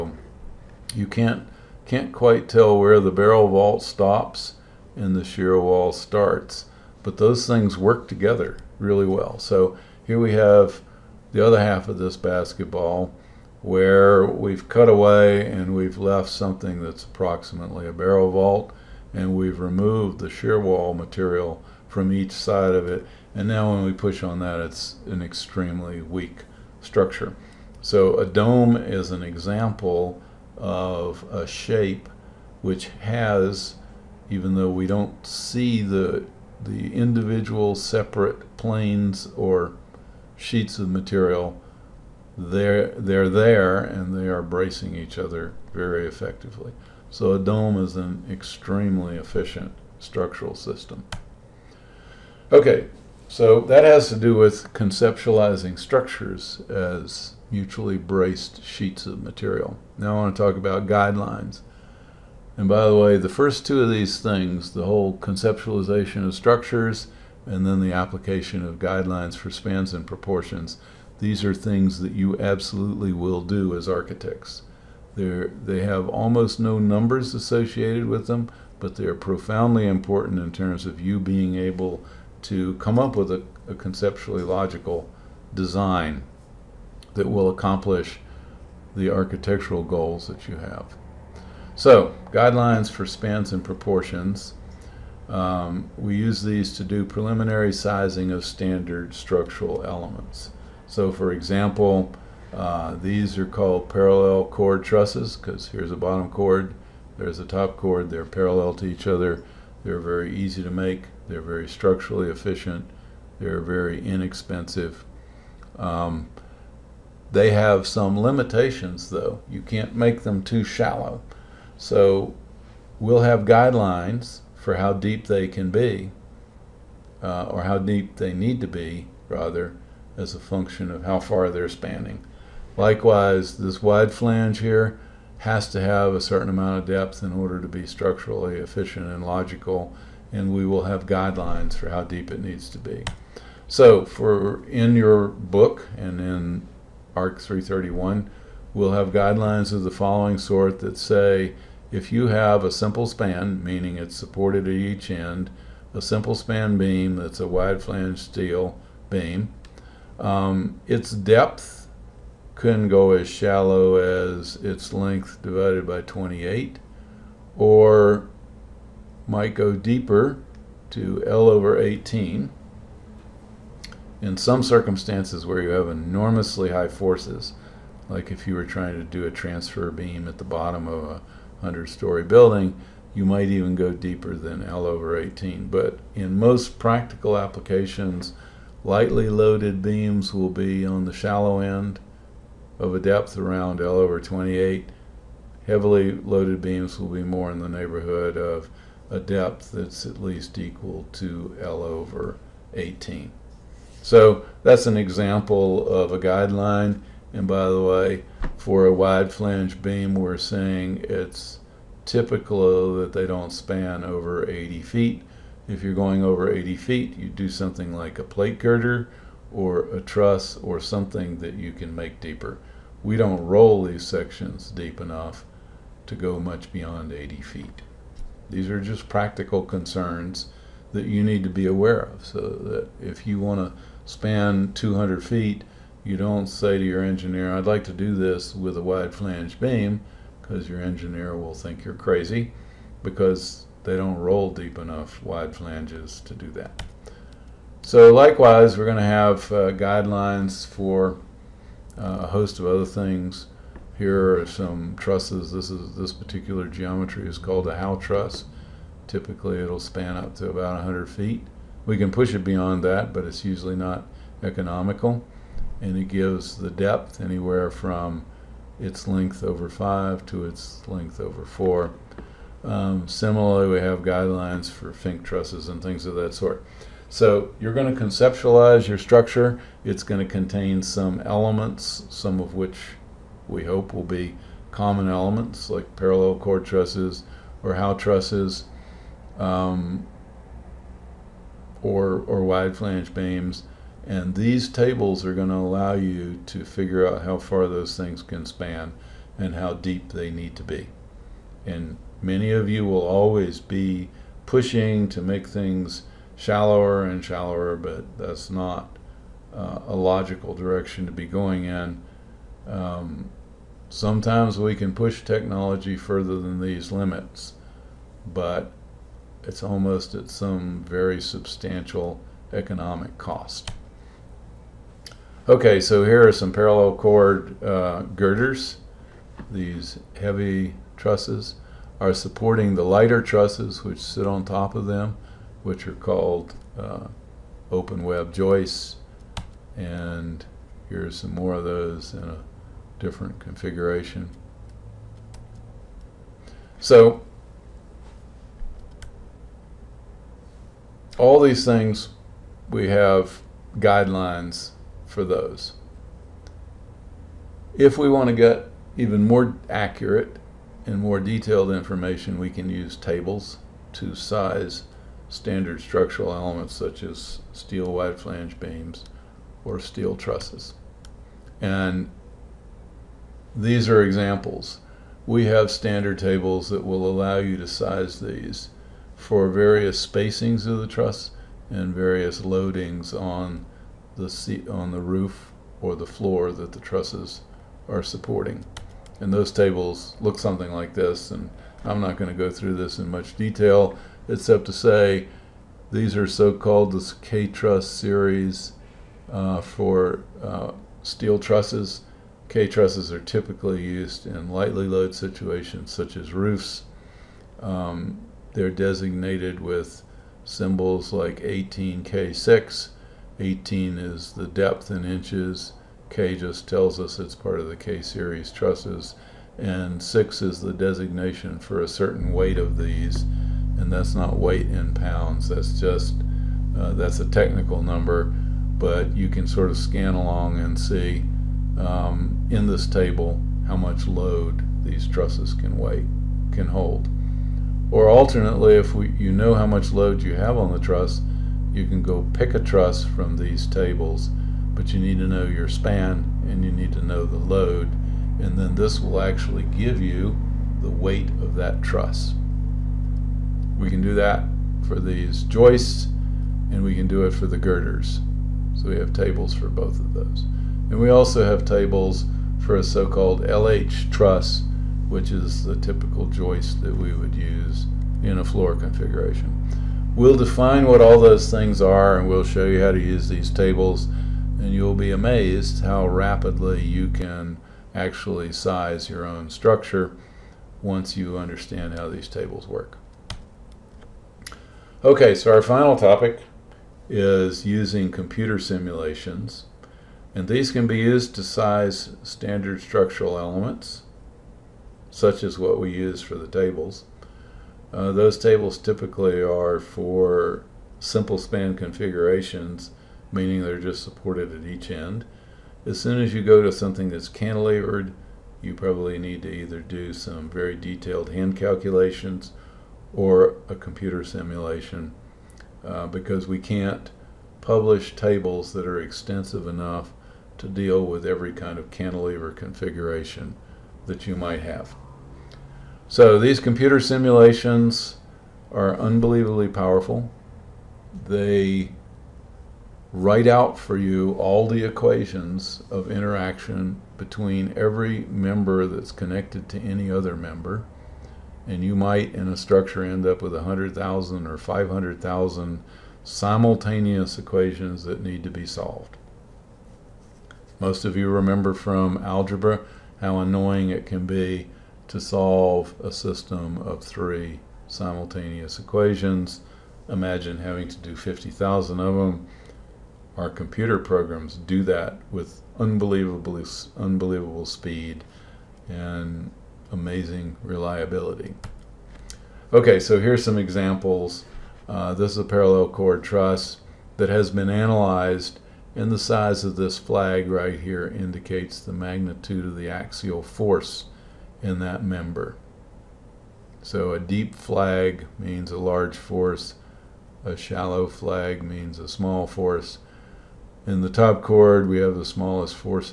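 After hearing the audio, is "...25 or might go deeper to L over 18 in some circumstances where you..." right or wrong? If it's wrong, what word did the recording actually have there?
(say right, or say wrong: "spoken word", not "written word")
wrong: "28", not "25".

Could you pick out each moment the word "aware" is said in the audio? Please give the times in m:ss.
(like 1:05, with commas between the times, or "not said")
3:51.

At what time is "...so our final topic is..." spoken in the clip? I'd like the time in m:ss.
8:05.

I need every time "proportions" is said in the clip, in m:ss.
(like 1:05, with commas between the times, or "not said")
1:10, 1:33.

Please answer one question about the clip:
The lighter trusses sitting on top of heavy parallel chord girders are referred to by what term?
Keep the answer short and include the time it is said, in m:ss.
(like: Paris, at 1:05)
open web joists, at 5:37.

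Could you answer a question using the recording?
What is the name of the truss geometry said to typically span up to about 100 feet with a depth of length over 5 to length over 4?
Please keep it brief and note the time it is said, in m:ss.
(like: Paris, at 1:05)
Howe truss, at 4:17.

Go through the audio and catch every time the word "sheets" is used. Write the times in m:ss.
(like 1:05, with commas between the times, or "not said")
0:40, 0:58.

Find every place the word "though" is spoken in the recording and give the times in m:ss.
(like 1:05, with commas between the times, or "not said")
0:34, 1:59.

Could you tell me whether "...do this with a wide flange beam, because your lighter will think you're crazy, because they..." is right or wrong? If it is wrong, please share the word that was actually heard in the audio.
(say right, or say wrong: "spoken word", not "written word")
wrong: "engineer", not "lighter".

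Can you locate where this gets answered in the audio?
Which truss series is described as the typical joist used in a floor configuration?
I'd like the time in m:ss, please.
7:43.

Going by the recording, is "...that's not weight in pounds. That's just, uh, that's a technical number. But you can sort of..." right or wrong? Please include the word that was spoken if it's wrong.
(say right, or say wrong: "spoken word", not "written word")
right.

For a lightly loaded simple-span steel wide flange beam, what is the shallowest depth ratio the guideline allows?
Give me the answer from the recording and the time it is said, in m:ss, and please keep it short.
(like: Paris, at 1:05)
L/28, at 3:13.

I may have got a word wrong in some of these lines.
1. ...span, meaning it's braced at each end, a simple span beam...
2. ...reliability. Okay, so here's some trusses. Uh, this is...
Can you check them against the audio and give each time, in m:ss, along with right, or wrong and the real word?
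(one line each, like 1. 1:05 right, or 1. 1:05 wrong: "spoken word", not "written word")
1. 2:33 wrong: "supported", not "braced"
2. 9:30 wrong: "examples", not "trusses".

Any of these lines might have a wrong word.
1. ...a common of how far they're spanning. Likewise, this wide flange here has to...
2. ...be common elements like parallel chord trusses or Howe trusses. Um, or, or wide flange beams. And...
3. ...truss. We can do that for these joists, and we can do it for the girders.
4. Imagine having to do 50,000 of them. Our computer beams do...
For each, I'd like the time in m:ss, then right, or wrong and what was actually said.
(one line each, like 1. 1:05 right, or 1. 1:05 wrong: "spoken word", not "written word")
1. 2:10 wrong: "function", not "common"
2. 4:44 right
3. 7:31 right
4. 9:20 wrong: "programs", not "beams".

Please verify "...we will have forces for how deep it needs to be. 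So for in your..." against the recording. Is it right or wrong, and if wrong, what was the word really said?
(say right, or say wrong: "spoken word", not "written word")
wrong: "guidelines", not "forces".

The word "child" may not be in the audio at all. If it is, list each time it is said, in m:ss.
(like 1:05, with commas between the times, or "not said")
not said.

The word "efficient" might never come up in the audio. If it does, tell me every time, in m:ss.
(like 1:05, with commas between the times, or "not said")
0:49, 1:52, 2:18.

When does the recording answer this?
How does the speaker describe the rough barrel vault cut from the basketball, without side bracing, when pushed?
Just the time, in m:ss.
0:25.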